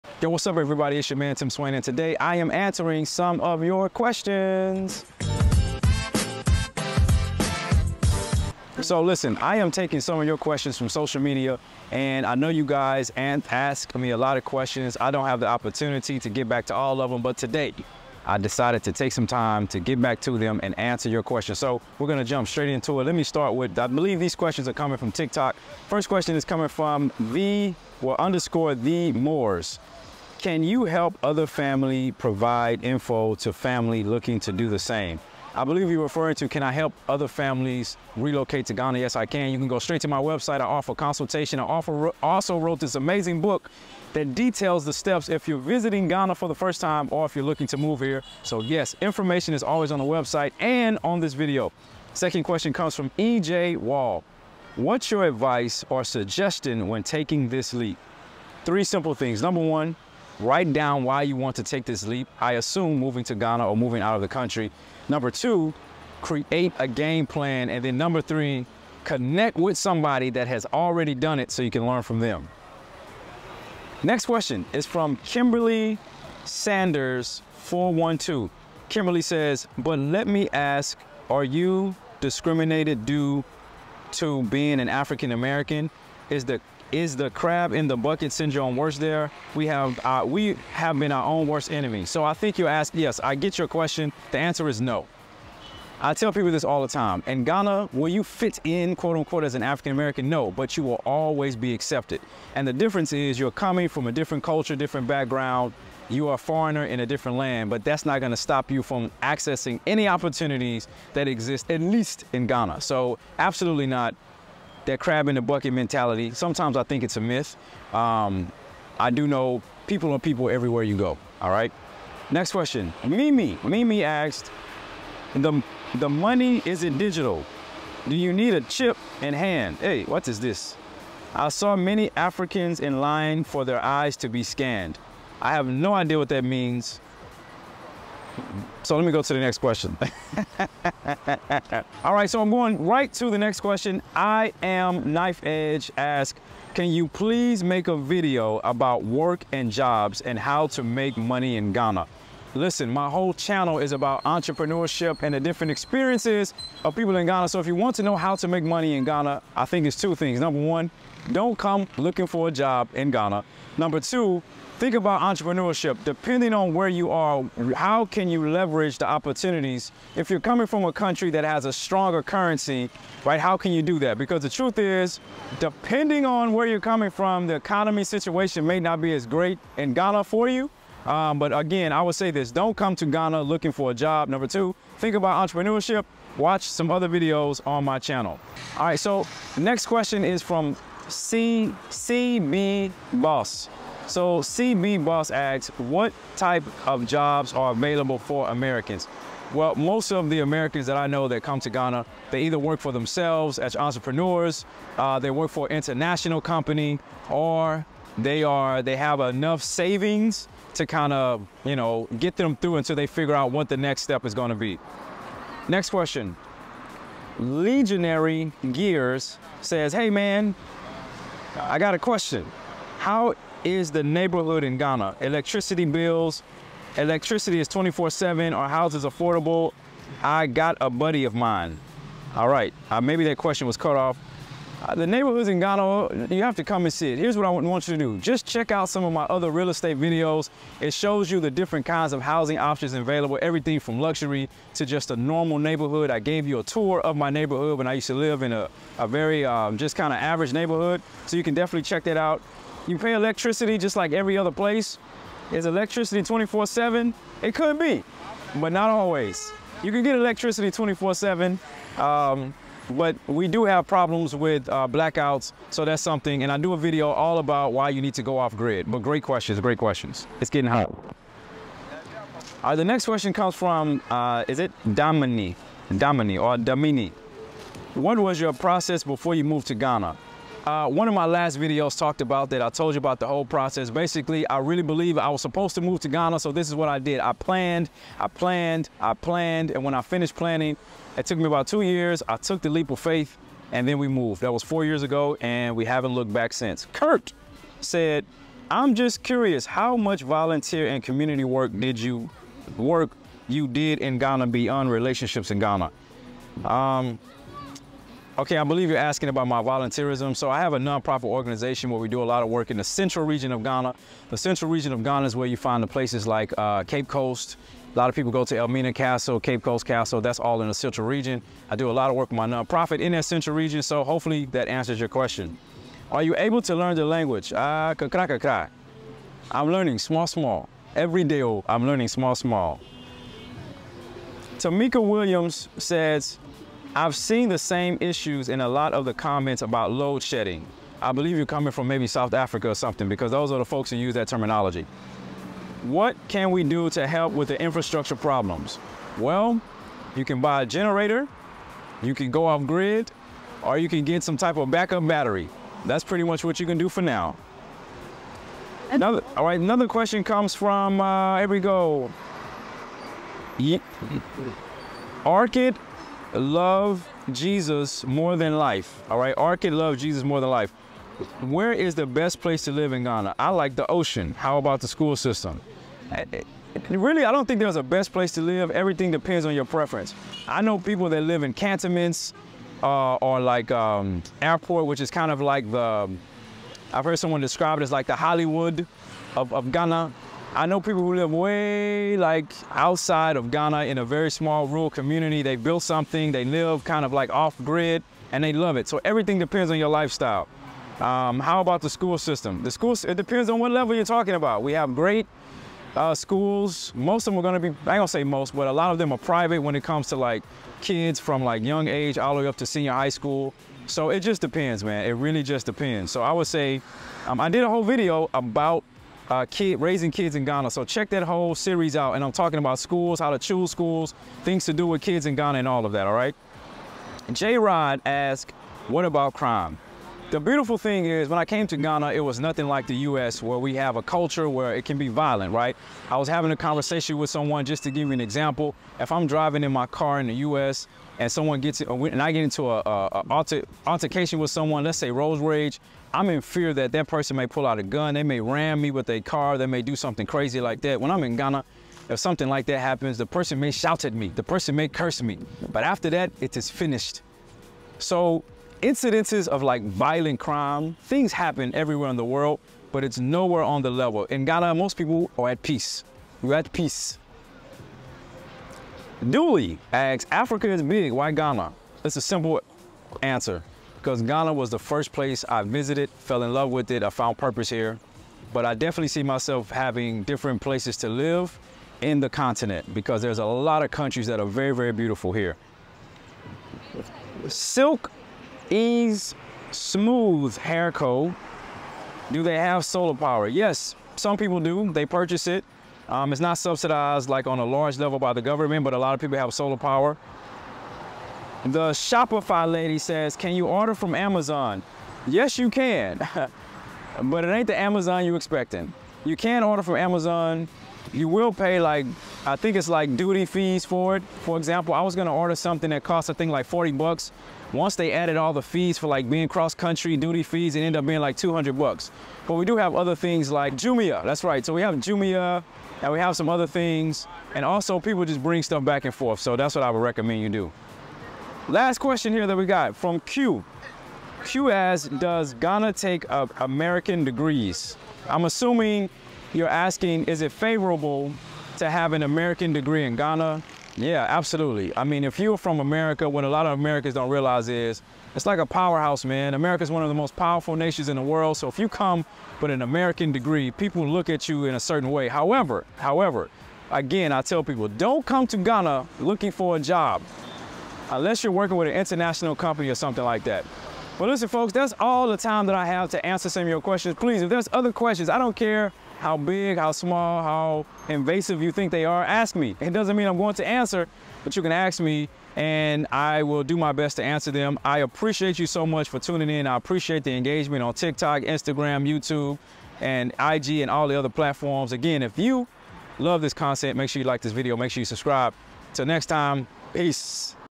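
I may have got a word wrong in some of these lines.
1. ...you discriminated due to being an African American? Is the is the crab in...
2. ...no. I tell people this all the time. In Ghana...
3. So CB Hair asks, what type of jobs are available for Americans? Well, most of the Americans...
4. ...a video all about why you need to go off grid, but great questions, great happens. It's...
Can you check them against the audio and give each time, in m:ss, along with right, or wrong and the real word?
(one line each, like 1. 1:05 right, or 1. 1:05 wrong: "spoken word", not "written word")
1. 1:21 right
2. 1:34 right
3. 3:14 wrong: "Boss", not "Hair"
4. 4:26 wrong: "questions", not "happens".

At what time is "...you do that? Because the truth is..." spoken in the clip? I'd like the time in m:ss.
2:53.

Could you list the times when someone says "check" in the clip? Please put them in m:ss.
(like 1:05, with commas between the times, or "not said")
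3:58, 4:11, 7:00.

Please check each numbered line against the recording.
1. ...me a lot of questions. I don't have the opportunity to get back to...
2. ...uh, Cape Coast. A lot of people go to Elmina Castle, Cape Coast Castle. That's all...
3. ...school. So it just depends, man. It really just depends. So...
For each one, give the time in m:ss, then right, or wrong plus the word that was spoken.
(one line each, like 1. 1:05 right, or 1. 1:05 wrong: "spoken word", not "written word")
1. 0:13 right
2. 5:16 right
3. 6:53 right.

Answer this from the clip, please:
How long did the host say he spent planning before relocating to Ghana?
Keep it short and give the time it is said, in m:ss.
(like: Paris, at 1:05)
2 years, at 4:51.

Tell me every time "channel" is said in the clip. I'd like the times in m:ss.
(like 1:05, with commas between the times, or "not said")
2:33, 3:07.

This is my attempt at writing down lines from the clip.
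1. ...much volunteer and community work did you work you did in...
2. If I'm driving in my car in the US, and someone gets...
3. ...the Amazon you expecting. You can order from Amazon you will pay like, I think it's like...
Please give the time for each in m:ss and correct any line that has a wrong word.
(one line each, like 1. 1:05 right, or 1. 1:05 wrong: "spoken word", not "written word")
1. 4:59 right
2. 7:18 right
3. 8:27 right.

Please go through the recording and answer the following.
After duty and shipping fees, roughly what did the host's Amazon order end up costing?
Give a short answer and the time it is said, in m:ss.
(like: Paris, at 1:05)
$200, at 8:41.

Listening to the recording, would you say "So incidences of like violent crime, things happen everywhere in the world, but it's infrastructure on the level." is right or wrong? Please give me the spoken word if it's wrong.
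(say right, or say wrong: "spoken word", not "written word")
wrong: "nowhere", not "infrastructure".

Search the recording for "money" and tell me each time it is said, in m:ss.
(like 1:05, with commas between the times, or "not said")
2:06, 2:31, 2:38.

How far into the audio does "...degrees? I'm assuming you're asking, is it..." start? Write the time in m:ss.
8:57.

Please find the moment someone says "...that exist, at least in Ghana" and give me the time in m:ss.
1:51.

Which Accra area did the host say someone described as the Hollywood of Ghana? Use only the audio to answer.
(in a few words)
Airport.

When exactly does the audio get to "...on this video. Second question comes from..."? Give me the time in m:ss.
0:51.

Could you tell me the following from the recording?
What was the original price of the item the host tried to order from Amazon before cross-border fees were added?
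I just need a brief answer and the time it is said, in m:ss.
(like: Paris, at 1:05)
$40, at 8:36.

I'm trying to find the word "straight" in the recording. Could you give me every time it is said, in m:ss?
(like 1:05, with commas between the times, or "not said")
0:22, 0:39.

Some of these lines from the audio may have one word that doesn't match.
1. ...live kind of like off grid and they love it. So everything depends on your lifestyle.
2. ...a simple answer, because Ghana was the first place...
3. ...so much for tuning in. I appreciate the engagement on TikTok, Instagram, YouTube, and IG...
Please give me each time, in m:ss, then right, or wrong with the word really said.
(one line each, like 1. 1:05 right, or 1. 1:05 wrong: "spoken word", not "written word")
1. 6:36 right
2. 7:52 right
3. 9:38 right.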